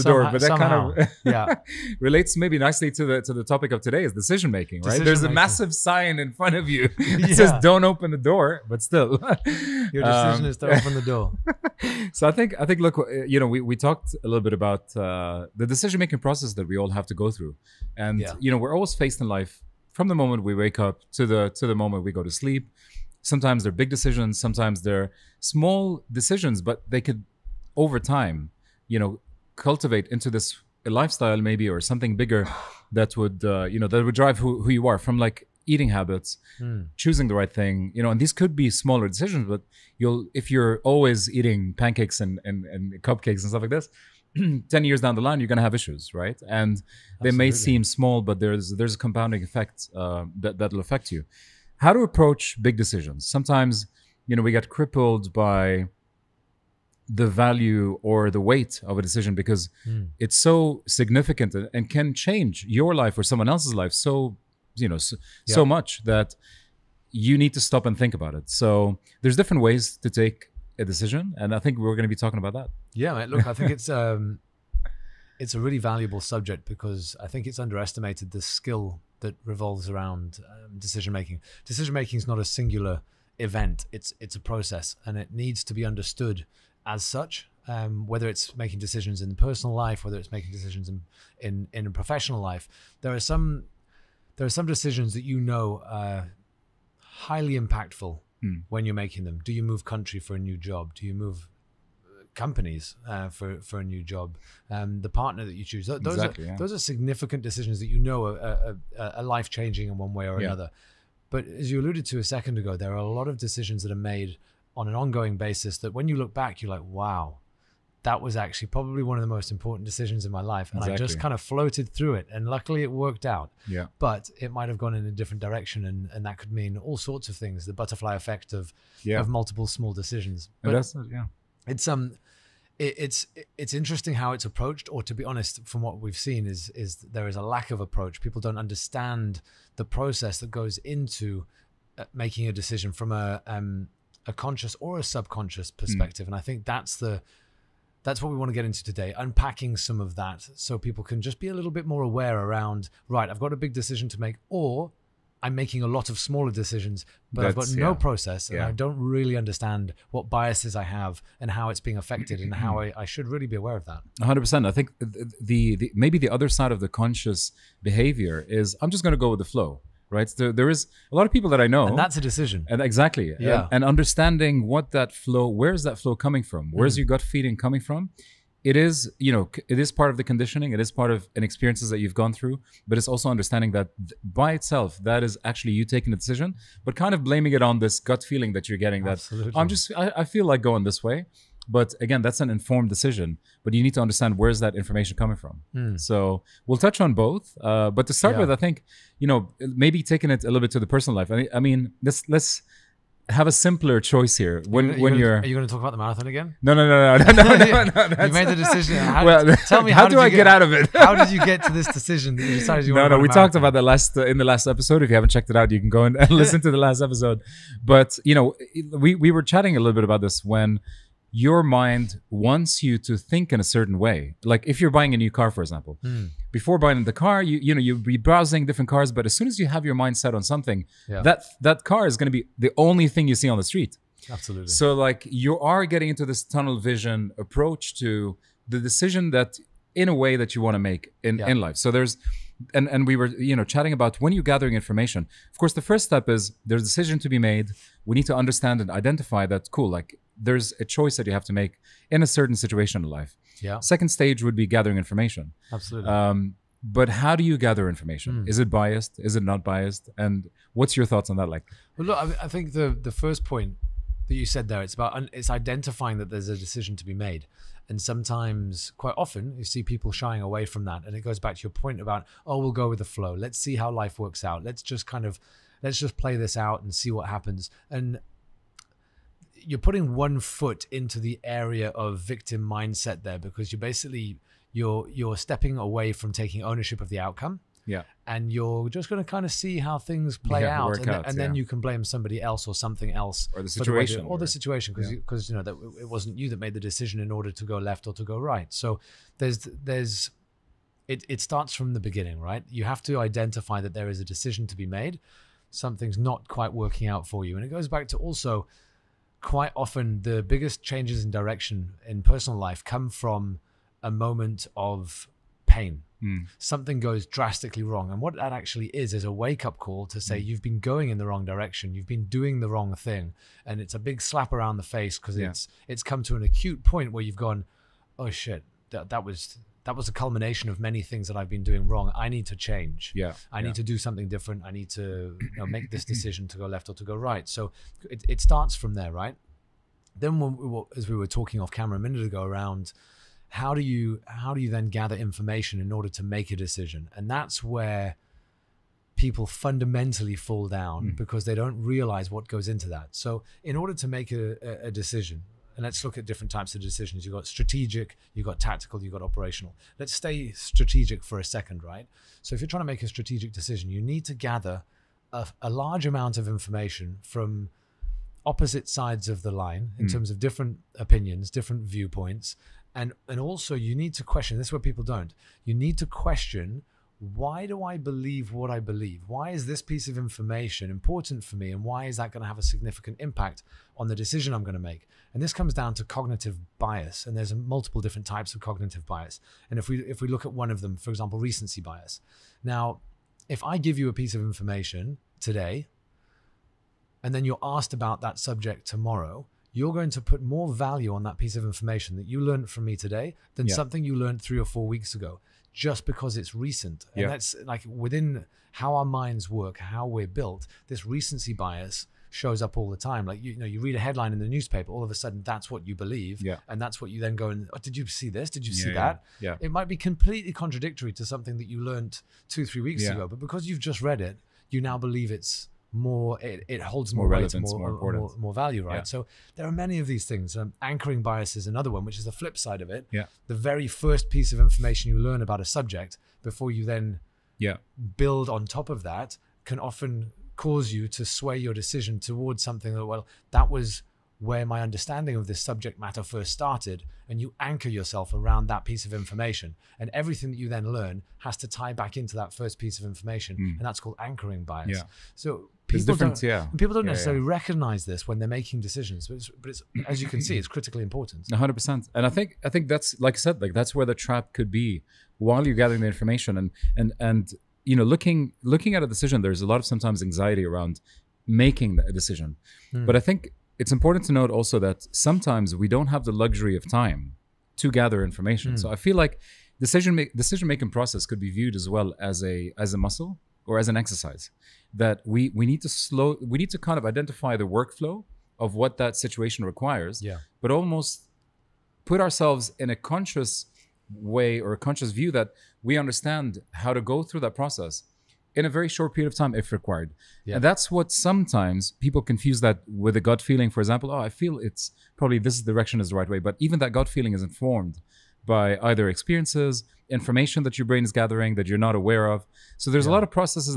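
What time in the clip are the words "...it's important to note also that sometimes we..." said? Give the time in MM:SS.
07:53.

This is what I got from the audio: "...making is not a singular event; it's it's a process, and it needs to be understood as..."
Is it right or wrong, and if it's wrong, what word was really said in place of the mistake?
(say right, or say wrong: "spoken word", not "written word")
right.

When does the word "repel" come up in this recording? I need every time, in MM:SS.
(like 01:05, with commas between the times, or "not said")
not said.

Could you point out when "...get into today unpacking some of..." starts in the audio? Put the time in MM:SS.
02:28.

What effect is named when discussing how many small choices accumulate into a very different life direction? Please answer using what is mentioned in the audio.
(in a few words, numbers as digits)
butterfly effect.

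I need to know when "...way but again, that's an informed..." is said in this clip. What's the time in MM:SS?
03:11.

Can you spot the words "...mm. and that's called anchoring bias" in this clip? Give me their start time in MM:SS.
07:33.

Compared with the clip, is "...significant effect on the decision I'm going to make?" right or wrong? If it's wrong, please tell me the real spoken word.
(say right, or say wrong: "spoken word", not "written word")
wrong: "impact", not "effect".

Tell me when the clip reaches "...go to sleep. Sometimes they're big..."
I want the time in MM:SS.
00:22.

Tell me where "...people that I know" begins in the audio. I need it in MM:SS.
02:51.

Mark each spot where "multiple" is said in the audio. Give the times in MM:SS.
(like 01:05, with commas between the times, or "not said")
02:09, 06:27.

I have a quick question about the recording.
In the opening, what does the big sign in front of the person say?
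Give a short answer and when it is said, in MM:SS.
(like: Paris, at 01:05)
Don't open the door, at 00:07.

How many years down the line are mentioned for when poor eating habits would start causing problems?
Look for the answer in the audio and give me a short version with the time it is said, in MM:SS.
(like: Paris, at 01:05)
10, at 00:44.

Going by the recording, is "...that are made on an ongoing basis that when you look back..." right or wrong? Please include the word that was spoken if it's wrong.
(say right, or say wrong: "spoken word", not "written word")
right.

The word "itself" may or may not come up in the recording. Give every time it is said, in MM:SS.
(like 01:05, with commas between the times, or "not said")
03:04.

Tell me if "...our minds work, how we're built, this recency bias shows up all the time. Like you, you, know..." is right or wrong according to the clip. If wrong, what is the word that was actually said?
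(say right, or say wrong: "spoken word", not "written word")
right.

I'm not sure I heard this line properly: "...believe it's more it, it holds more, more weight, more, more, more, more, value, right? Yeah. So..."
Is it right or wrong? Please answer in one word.
right.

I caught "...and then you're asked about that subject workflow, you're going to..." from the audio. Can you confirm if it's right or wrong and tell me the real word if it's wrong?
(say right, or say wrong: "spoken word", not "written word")
wrong: "tomorrow", not "workflow".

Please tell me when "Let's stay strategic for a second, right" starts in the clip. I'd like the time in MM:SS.
05:59.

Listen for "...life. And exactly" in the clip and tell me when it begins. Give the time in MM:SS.
02:00.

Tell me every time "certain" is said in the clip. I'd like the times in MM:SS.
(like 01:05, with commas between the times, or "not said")
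03:43, 04:12.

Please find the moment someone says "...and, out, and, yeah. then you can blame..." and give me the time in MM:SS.
04:50.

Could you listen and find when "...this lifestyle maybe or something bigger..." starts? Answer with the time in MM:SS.
00:30.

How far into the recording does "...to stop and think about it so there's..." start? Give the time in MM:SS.
01:07.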